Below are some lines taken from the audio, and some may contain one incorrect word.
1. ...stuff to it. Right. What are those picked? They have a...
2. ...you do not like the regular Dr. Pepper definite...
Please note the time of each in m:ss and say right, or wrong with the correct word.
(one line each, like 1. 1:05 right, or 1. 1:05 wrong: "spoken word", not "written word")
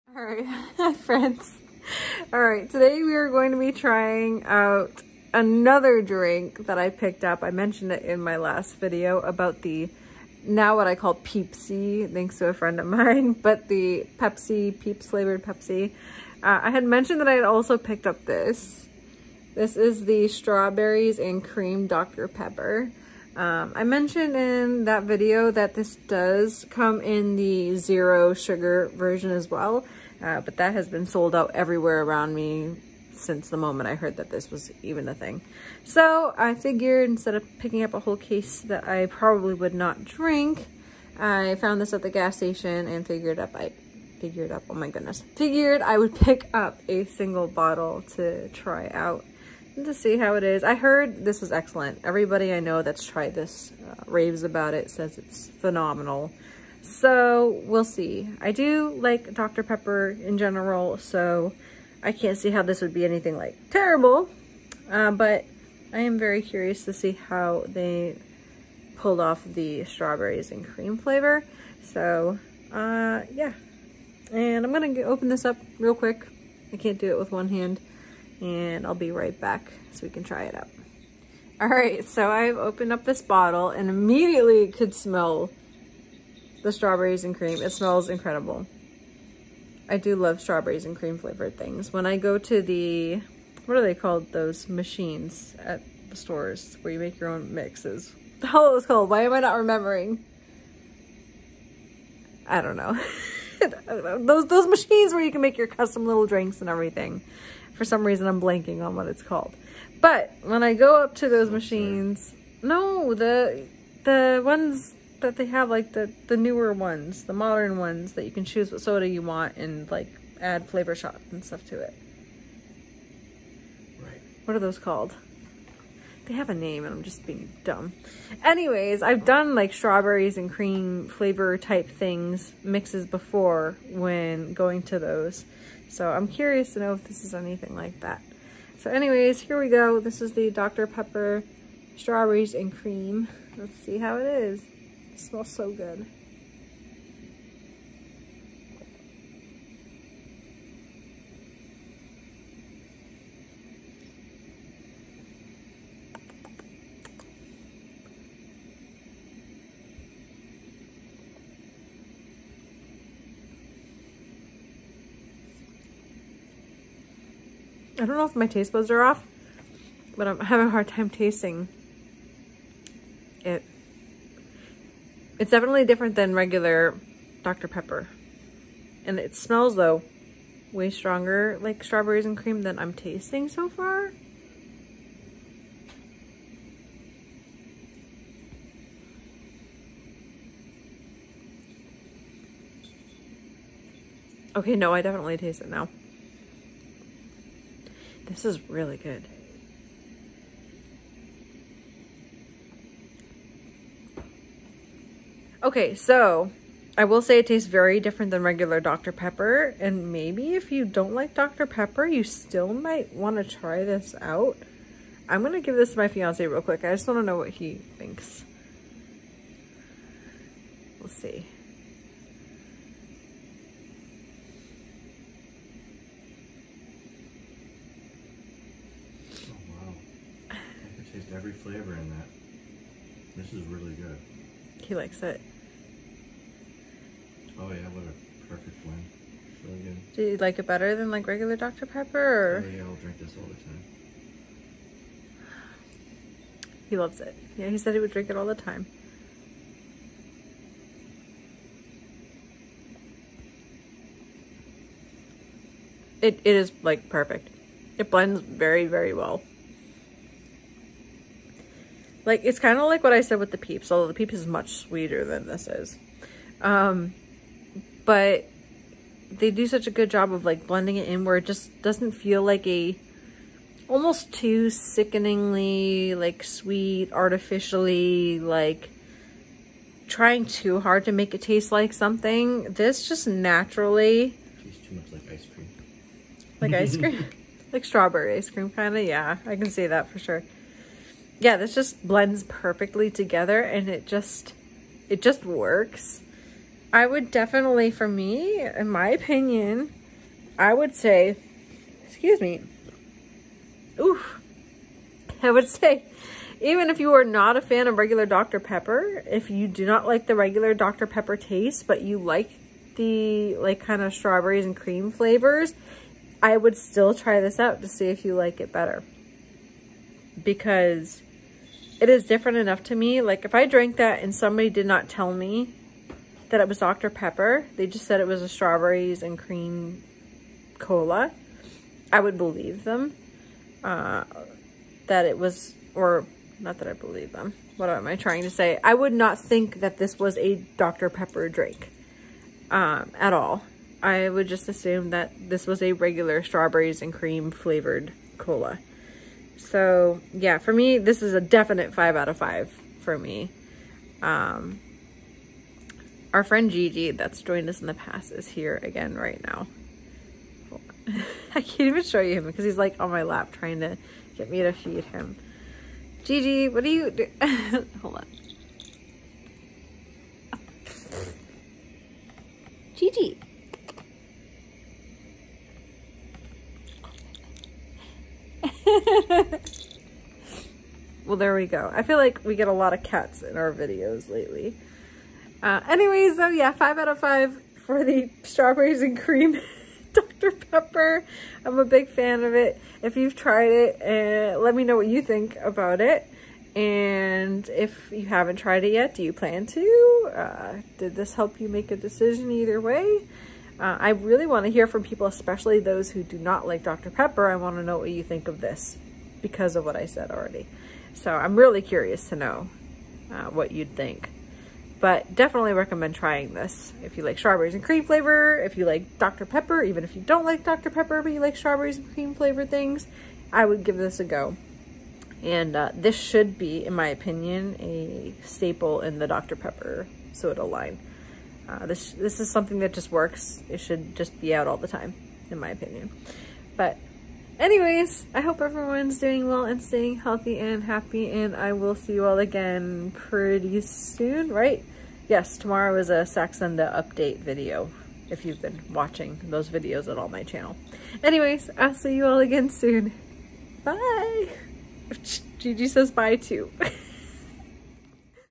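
1. 2:01 wrong: "called", not "picked"
2. 5:09 wrong: "taste", not "definite".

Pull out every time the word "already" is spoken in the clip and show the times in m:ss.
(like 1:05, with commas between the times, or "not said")
6:50.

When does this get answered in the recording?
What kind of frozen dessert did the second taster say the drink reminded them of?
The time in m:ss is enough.
4:47.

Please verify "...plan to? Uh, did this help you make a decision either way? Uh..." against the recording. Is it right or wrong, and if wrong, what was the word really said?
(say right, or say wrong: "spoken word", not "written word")
right.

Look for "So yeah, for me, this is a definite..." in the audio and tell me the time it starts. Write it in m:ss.
5:49.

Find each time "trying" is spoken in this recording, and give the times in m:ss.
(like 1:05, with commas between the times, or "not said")
0:03, 4:40, 5:38, 6:03, 6:56.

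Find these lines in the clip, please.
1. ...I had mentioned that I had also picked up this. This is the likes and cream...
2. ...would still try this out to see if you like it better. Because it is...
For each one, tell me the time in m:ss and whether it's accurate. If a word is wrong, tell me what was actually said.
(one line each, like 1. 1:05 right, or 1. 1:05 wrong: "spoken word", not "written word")
1. 0:16 wrong: "strawberries", not "likes"
2. 5:16 right.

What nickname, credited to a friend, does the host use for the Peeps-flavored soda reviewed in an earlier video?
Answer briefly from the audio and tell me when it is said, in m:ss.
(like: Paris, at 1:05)
Peepsy, at 0:11.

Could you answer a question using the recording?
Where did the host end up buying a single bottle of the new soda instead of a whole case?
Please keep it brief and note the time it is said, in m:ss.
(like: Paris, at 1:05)
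the gas station, at 0:42.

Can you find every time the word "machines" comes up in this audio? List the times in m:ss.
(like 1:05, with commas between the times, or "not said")
1:34, 1:44, 1:51.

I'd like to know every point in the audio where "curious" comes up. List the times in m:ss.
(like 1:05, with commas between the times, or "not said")
1:06, 2:16, 6:51.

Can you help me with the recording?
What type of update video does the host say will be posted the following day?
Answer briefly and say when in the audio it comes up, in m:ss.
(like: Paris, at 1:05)
Saxenda update, at 7:26.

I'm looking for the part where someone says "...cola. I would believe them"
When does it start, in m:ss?
5:30.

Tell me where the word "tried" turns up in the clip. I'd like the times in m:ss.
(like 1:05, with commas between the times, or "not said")
0:53, 6:33, 6:38.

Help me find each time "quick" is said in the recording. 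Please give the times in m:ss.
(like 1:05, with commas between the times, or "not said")
1:15, 3:36.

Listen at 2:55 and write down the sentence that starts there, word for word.
It's definitely different than regular Dr.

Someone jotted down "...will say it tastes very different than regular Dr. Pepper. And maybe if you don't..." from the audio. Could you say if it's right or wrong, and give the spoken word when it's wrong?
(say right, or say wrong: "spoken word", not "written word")
right.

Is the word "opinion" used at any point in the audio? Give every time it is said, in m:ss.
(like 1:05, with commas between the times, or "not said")
4:59, 7:07, 7:15.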